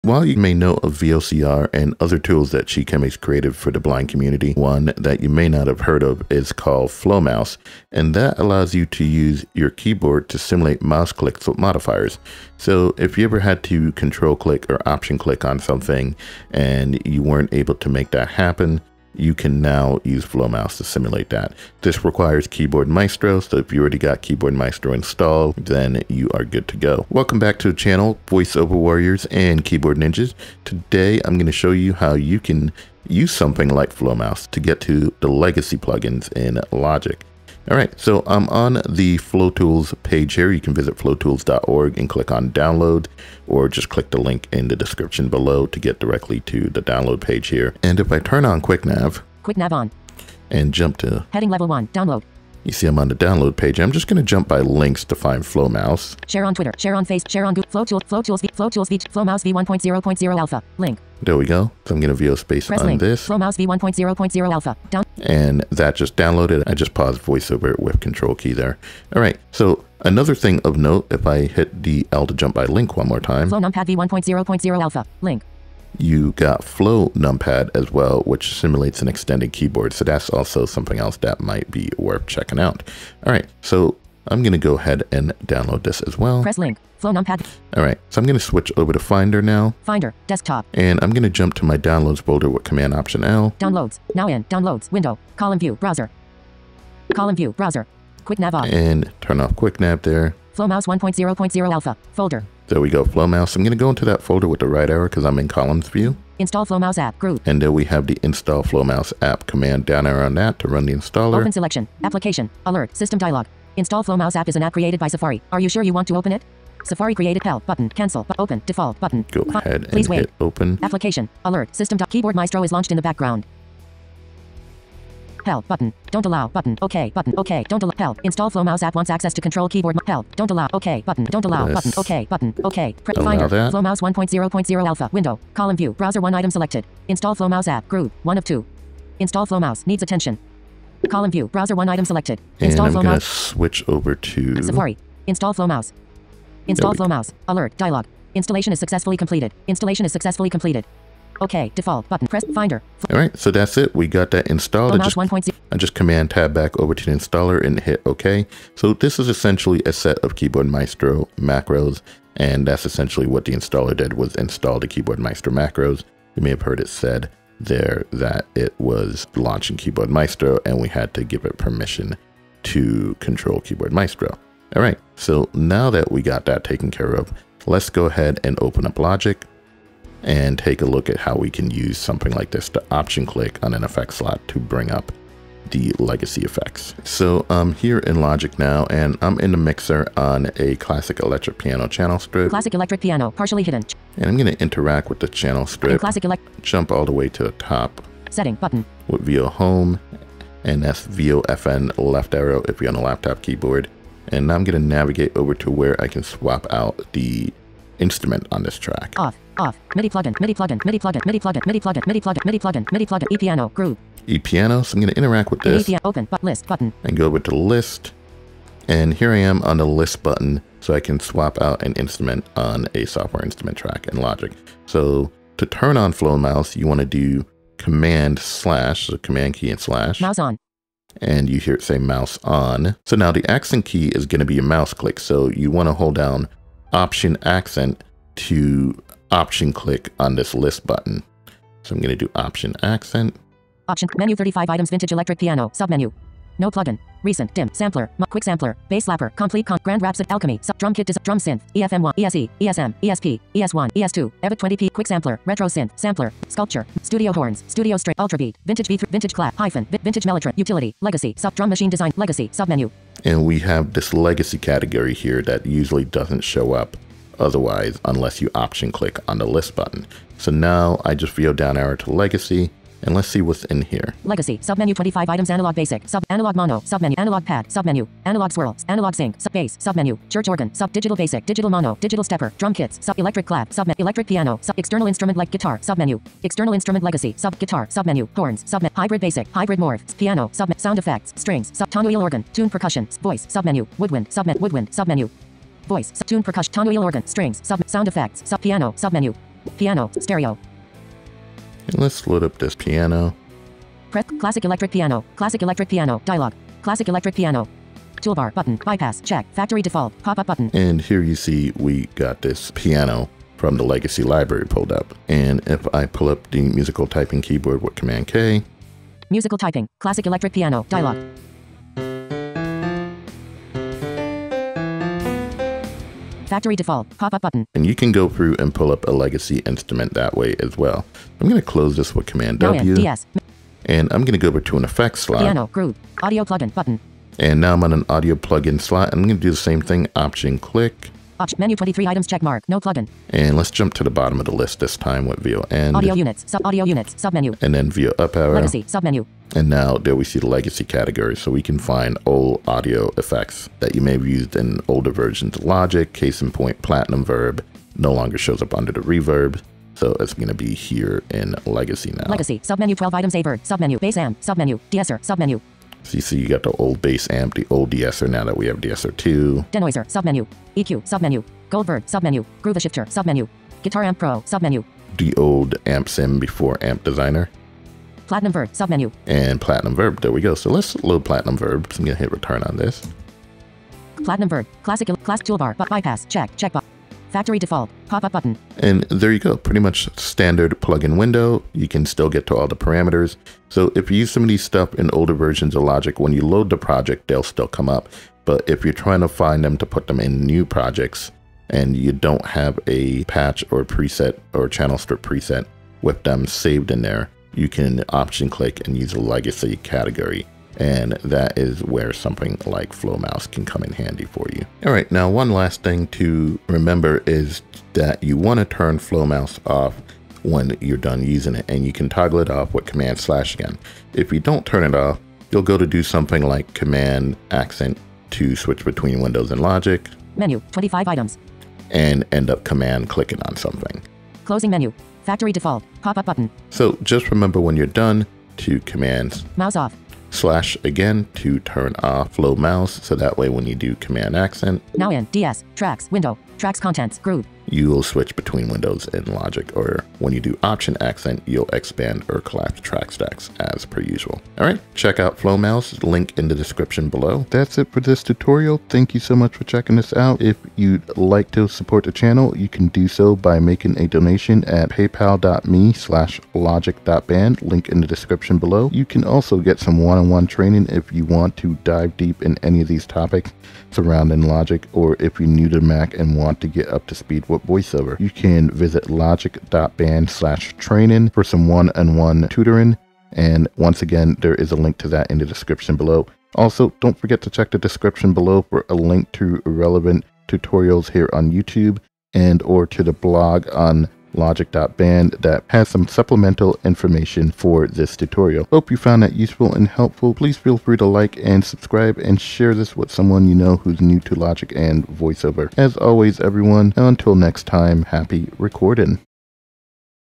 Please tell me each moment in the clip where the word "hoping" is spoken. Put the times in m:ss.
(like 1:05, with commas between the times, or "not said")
not said.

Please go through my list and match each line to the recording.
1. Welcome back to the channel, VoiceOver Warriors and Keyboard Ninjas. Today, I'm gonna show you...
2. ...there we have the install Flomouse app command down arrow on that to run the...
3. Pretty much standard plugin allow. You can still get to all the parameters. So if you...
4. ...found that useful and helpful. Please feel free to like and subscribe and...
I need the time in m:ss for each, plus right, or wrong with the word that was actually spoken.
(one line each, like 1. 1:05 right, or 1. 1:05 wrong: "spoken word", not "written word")
1. 0:27 right
2. 1:47 right
3. 6:29 wrong: "window", not "allow"
4. 8:18 right.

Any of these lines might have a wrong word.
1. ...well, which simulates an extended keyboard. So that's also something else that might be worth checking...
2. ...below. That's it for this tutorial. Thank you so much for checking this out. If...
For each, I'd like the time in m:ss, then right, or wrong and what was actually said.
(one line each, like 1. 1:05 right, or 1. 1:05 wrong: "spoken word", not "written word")
1. 1:17 right
2. 7:37 right.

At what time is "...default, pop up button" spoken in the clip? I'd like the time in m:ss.
5:09.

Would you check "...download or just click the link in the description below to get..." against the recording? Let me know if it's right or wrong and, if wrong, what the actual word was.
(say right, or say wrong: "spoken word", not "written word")
right.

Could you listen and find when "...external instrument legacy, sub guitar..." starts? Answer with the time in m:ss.
4:46.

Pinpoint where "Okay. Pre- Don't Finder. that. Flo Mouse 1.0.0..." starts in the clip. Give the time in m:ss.
2:12.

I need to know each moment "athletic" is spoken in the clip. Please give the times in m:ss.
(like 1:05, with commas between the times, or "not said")
not said.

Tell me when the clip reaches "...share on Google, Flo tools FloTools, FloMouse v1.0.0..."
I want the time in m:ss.
0:57.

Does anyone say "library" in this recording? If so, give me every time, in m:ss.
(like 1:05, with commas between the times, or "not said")
5:14.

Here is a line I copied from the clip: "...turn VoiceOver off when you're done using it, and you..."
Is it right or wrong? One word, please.
wrong.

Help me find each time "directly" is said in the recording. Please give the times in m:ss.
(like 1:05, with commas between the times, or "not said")
0:45.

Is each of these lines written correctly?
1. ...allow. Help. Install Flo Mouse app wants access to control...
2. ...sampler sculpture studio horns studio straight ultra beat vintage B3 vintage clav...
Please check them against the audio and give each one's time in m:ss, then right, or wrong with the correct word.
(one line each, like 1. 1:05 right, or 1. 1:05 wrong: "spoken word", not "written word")
1. 2:07 right
2. 4:15 right.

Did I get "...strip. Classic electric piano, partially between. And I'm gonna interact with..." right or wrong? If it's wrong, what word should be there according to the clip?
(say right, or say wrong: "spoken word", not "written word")
wrong: "hidden", not "between".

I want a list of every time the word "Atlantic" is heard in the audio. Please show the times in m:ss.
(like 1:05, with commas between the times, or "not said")
not said.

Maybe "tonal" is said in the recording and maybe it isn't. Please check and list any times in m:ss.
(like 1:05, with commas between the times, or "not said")
4:51, 4:56.